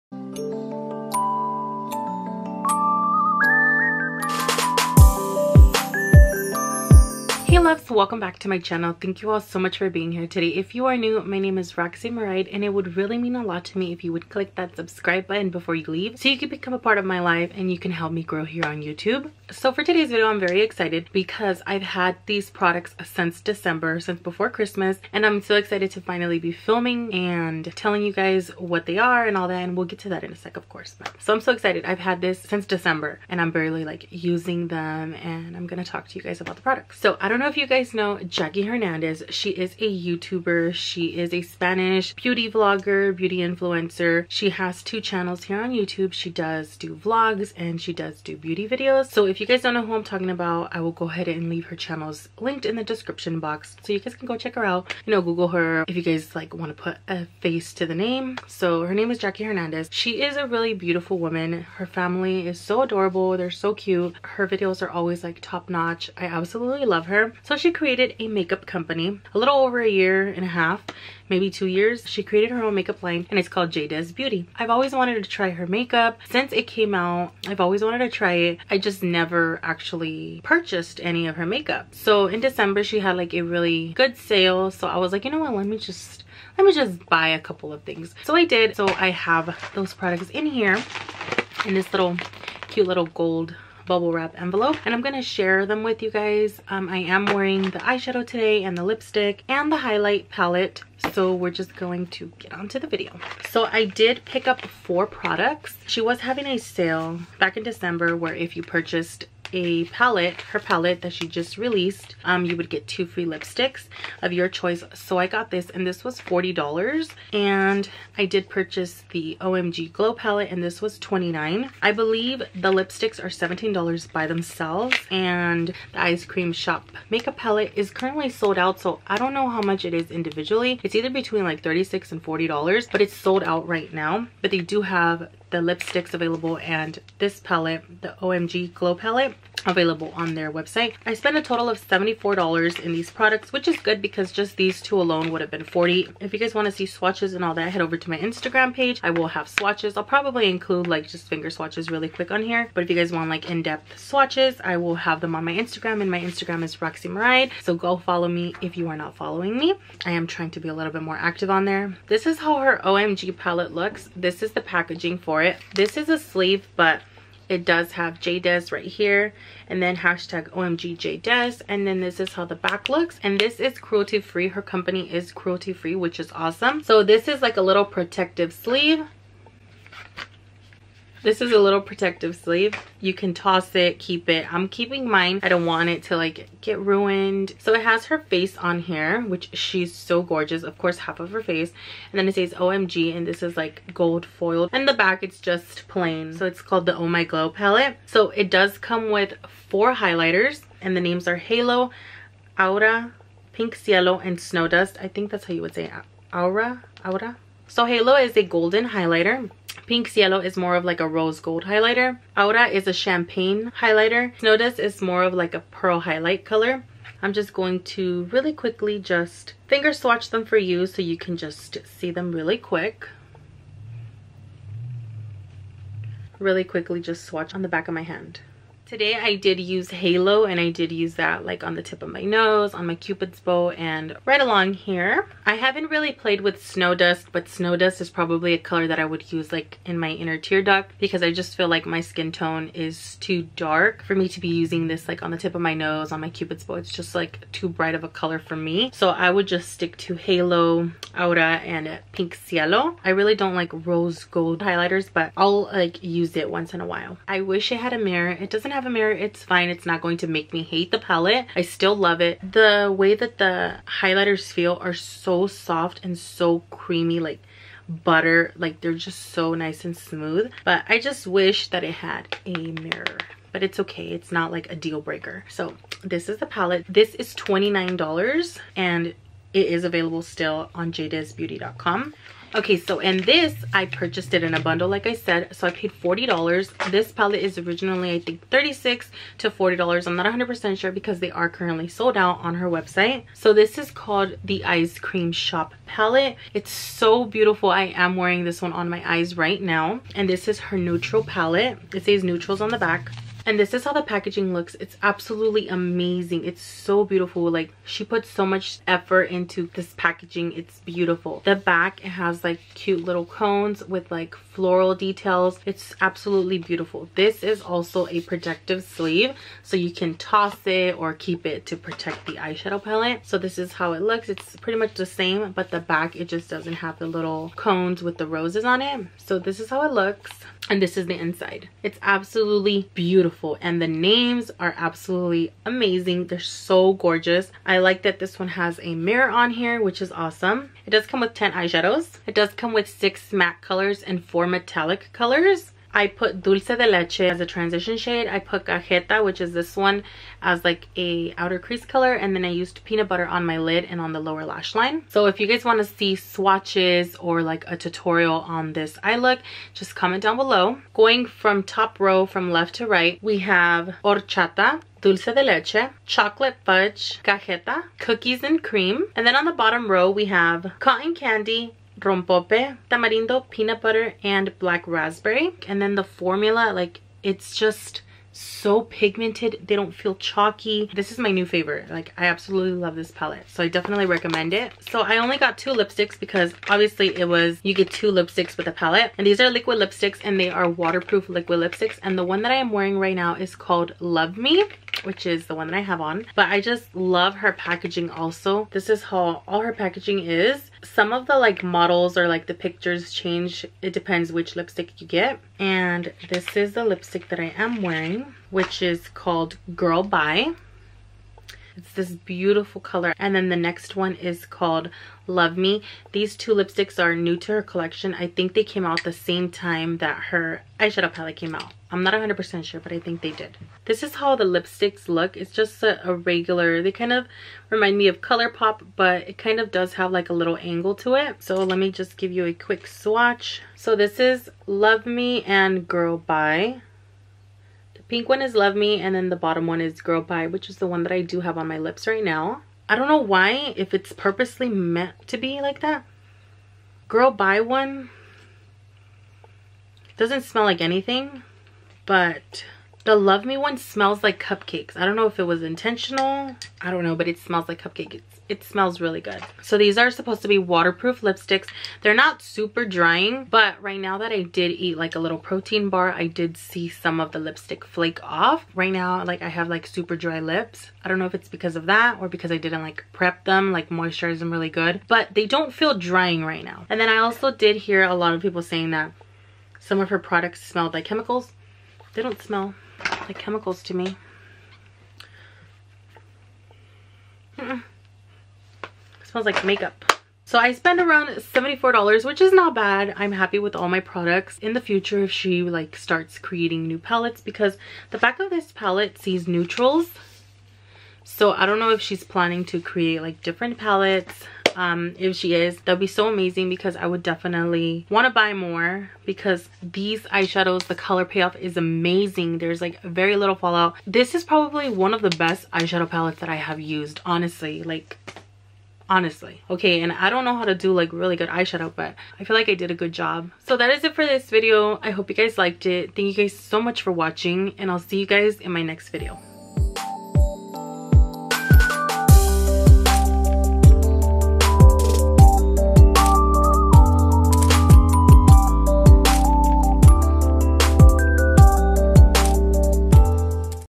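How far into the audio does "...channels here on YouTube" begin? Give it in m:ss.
0:45.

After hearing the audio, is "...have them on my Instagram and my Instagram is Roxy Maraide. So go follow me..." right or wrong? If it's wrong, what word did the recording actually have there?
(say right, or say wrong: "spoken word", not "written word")
right.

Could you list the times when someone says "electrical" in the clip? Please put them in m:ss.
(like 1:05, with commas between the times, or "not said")
not said.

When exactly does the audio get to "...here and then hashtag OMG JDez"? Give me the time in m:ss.
2:48.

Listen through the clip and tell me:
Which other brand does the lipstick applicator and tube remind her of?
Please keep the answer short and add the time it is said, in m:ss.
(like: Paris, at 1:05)
ColourPop, at 7:08.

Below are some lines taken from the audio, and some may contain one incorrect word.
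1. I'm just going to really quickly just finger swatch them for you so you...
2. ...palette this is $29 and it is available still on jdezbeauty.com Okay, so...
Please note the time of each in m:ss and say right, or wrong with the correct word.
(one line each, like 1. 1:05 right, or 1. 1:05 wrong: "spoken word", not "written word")
1. 3:37 right
2. 4:36 right.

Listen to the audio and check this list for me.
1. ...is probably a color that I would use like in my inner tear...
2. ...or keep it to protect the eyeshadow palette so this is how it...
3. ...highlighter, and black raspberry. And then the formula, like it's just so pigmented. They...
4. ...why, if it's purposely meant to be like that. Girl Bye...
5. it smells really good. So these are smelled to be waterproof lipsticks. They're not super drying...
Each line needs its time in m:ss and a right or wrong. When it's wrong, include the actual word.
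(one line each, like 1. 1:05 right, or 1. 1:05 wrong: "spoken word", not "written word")
1. 3:58 right
2. 5:20 right
3. 6:13 wrong: "butter", not "highlighter"
4. 7:23 right
5. 7:38 wrong: "supposed", not "smelled".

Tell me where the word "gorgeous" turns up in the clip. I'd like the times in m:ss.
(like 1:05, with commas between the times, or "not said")
3:10, 5:36.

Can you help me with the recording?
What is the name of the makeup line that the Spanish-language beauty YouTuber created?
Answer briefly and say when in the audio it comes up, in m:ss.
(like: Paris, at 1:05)
JDez Beauty, at 1:13.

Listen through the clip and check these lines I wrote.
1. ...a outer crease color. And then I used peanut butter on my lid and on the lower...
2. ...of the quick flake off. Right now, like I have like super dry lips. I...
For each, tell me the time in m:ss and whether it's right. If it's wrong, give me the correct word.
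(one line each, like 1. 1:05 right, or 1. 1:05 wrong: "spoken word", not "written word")
1. 5:50 right
2. 7:47 wrong: "lipstick", not "quick".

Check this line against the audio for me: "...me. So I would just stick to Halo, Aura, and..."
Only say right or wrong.
right.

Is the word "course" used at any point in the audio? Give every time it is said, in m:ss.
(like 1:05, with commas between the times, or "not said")
0:30, 3:10.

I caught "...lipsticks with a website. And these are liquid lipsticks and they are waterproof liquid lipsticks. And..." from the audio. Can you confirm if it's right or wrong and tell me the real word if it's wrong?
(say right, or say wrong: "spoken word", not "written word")
wrong: "palette", not "website".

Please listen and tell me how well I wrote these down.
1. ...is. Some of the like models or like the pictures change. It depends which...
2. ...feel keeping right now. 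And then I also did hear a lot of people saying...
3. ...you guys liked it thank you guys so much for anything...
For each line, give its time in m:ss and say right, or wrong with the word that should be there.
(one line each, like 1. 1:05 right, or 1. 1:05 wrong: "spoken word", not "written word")
1. 6:40 right
2. 7:55 wrong: "drying", not "keeping"
3. 8:45 wrong: "watching", not "anything".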